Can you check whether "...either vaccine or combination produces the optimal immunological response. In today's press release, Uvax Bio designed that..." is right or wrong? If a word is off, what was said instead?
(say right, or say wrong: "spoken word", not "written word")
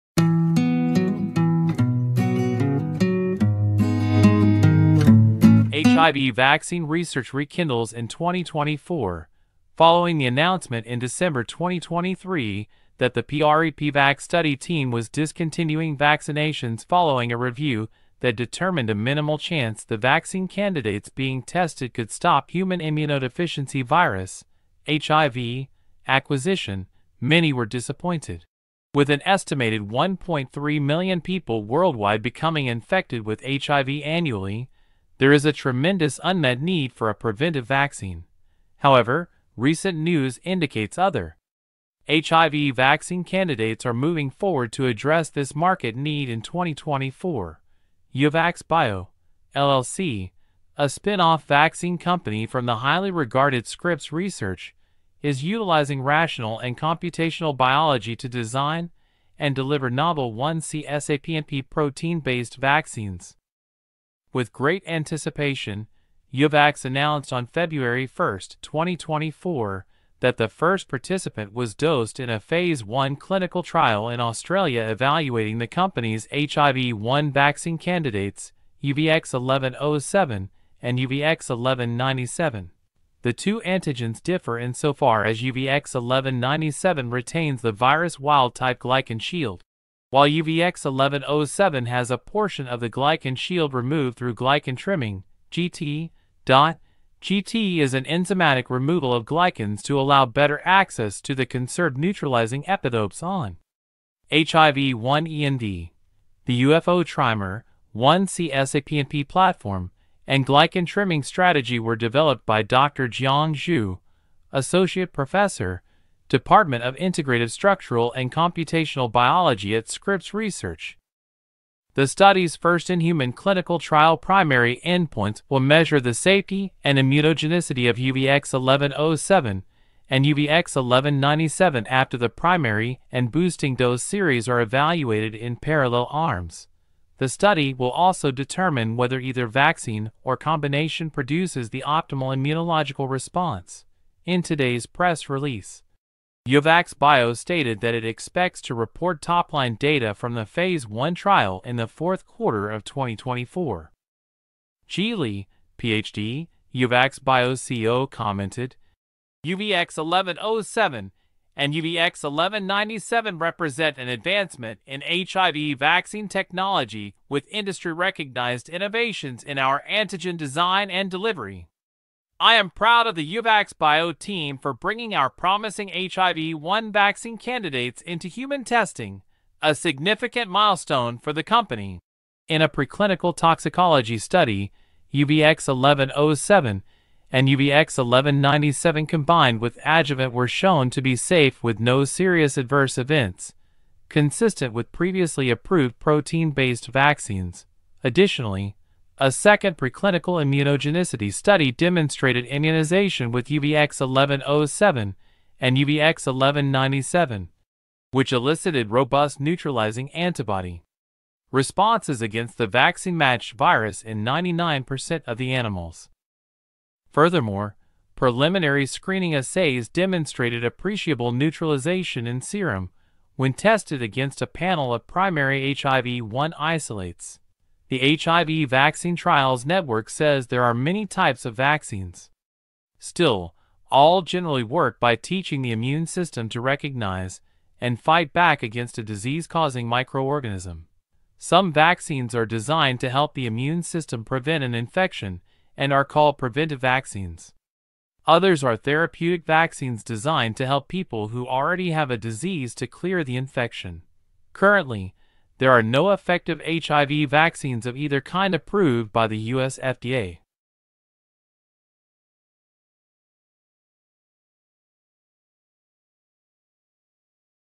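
wrong: "stated", not "designed".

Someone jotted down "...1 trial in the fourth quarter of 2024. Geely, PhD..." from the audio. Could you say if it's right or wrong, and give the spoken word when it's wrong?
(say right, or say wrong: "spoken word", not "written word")
right.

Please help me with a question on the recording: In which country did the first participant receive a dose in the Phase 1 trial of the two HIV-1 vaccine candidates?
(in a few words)
Australia.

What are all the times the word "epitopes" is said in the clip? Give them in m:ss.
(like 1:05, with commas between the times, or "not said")
1:42.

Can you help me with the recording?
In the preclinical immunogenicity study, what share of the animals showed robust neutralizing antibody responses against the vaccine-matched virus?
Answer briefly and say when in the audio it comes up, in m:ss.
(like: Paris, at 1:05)
99%, at 3:34.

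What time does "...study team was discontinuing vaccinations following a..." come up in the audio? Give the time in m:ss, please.
0:14.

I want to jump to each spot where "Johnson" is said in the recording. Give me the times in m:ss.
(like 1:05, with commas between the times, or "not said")
not said.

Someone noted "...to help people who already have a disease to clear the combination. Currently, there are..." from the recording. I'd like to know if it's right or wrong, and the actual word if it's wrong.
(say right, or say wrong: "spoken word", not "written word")
wrong: "infection", not "combination".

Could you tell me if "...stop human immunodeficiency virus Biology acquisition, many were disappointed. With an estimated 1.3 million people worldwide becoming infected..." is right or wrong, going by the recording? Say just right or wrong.
wrong.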